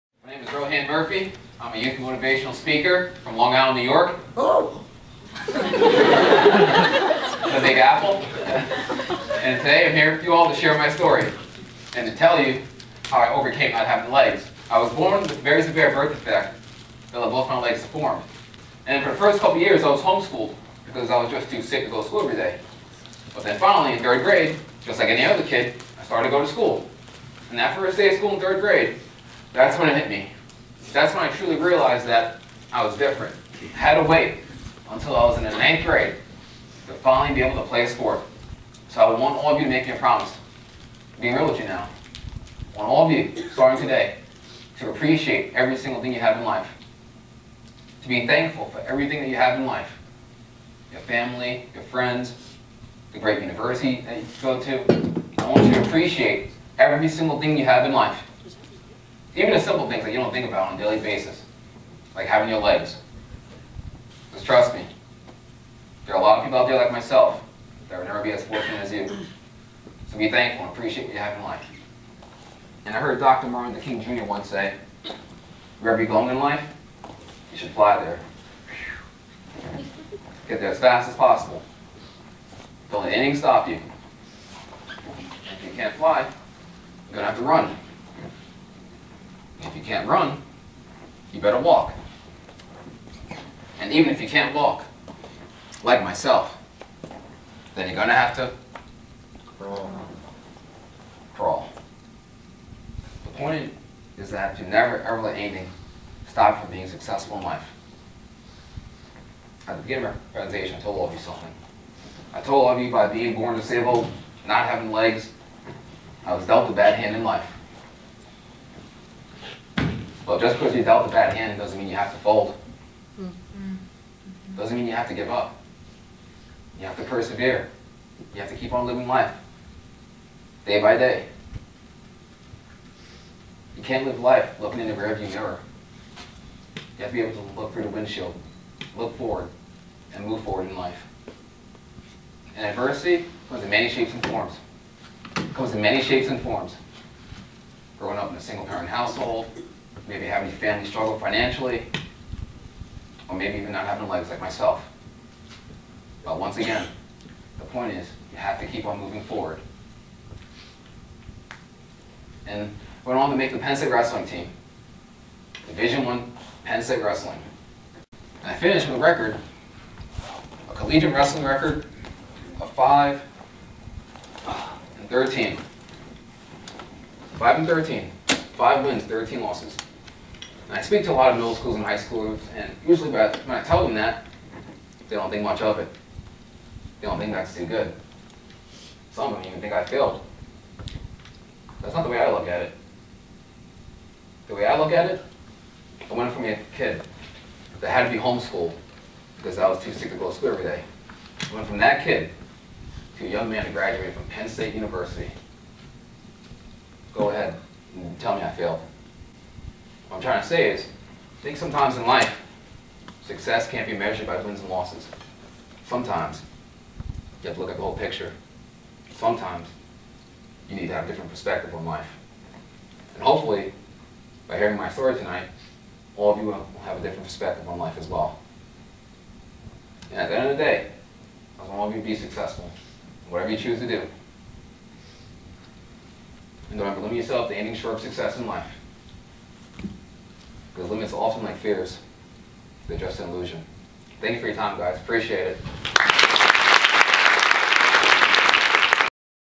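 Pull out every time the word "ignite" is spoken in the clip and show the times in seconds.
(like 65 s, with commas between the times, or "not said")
not said.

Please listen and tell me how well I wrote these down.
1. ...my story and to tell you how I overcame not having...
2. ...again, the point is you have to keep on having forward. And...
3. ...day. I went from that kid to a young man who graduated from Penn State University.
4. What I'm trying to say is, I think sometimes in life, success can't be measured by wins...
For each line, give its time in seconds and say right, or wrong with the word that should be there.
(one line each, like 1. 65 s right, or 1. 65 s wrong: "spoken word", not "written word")
1. 10 s right
2. 156 s wrong: "moving", not "having"
3. 200 s right
4. 210 s right.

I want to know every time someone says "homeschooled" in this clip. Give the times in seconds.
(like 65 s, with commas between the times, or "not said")
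20 s, 198 s.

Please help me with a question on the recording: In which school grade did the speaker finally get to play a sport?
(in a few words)
ninth grade.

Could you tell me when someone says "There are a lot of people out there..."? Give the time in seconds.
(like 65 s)
66 s.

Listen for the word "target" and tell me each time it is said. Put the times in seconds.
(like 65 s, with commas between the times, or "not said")
not said.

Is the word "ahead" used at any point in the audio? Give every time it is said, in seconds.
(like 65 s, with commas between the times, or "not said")
207 s.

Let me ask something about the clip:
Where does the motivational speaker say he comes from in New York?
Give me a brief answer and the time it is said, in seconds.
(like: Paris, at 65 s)
Long Island, at 3 s.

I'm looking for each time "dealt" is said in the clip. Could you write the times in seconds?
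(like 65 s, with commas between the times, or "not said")
116 s, 120 s.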